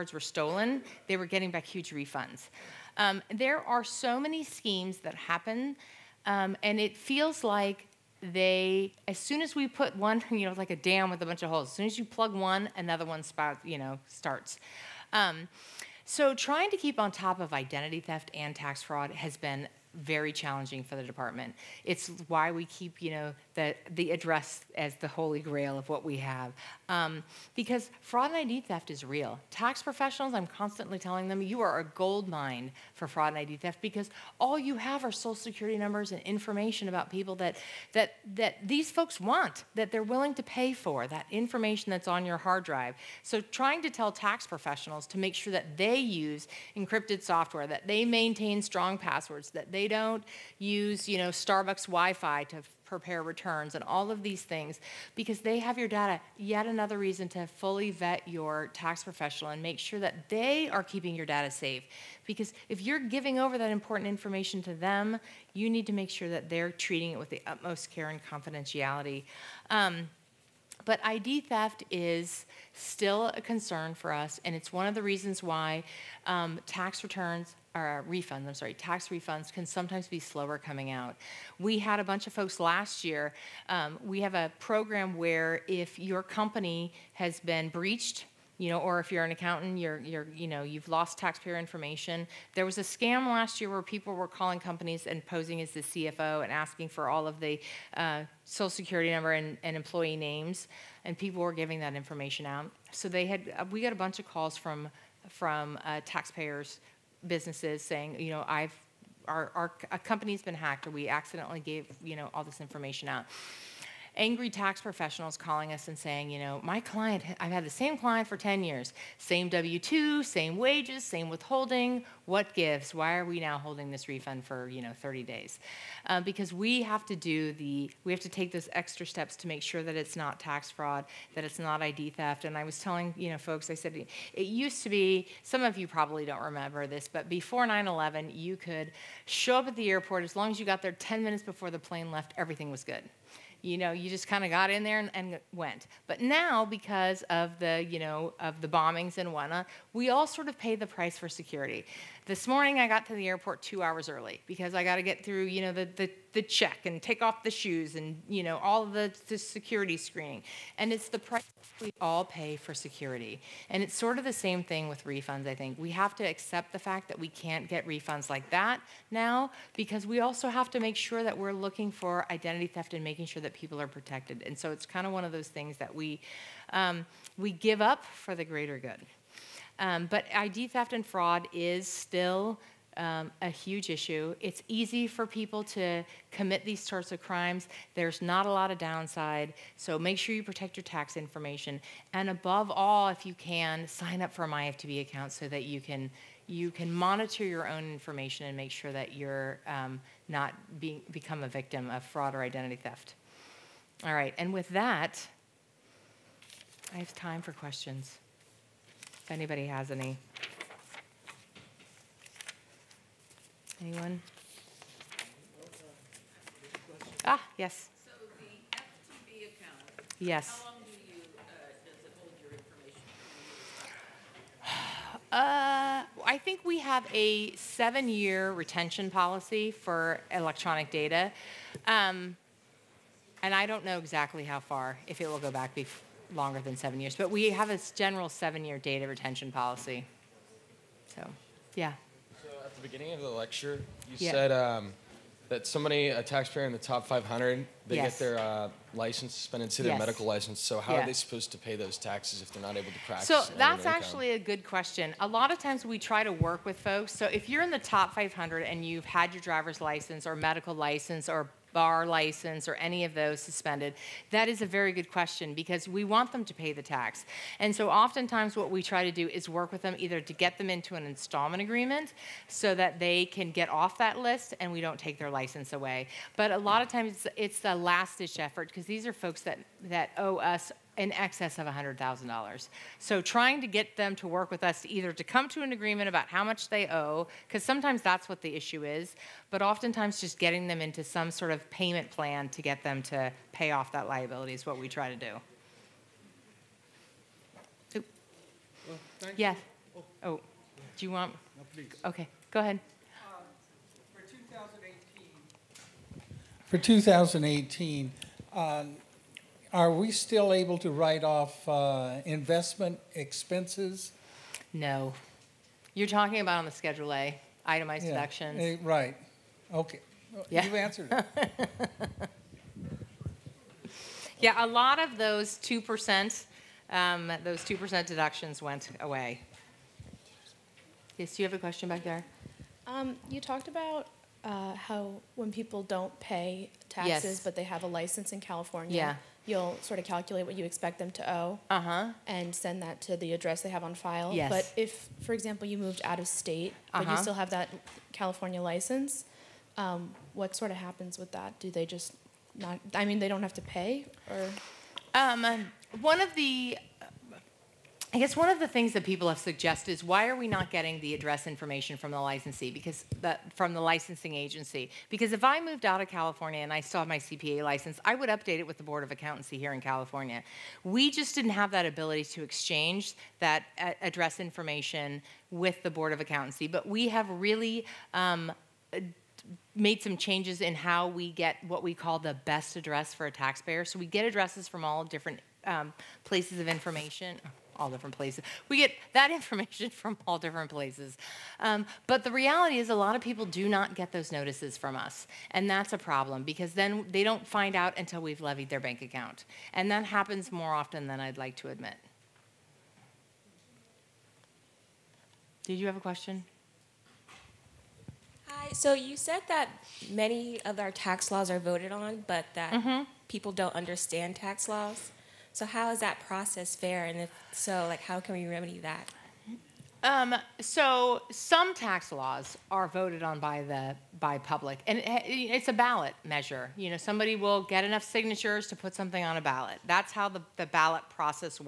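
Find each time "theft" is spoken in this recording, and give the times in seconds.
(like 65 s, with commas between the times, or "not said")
18 s, 28 s, 33 s, 71 s, 132 s, 172 s, 180 s, 202 s.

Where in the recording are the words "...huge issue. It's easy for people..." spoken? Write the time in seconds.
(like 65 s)
183 s.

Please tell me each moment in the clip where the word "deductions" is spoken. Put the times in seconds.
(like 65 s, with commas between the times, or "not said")
318 s, 328 s.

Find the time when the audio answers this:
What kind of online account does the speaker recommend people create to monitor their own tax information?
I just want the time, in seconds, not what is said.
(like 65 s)
194 s.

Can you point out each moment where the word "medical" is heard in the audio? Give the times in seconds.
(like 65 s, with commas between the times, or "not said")
249 s, 260 s.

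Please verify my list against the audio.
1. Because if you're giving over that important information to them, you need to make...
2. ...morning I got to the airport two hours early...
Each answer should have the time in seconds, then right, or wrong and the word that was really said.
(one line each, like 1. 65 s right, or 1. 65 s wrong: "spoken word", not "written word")
1. 62 s right
2. 152 s right.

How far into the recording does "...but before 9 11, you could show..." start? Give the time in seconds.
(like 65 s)
137 s.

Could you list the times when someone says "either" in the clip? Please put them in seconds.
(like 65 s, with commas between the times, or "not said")
269 s, 284 s.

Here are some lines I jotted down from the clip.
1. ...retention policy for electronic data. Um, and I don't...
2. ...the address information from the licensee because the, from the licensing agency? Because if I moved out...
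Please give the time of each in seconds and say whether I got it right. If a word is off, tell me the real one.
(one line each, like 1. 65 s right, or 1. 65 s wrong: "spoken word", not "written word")
1. 228 s right
2. 361 s right.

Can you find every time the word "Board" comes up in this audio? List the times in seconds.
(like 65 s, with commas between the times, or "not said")
368 s, 375 s.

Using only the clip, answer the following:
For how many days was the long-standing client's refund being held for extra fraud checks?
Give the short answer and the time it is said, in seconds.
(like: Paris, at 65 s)
30 days, at 125 s.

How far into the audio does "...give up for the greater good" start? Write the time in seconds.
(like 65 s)
177 s.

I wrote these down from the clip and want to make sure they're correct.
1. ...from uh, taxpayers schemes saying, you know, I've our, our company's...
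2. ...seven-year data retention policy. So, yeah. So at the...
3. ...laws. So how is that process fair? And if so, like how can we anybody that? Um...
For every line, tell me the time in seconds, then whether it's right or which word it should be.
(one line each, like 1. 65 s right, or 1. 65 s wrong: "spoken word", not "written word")
1. 105 s wrong: "businesses", not "schemes"
2. 238 s right
3. 414 s wrong: "remedy", not "anybody".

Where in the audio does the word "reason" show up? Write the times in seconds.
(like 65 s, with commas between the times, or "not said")
56 s, 75 s.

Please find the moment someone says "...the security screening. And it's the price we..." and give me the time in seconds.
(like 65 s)
159 s.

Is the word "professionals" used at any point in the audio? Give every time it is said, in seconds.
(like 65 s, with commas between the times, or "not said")
29 s, 44 s, 59 s, 114 s.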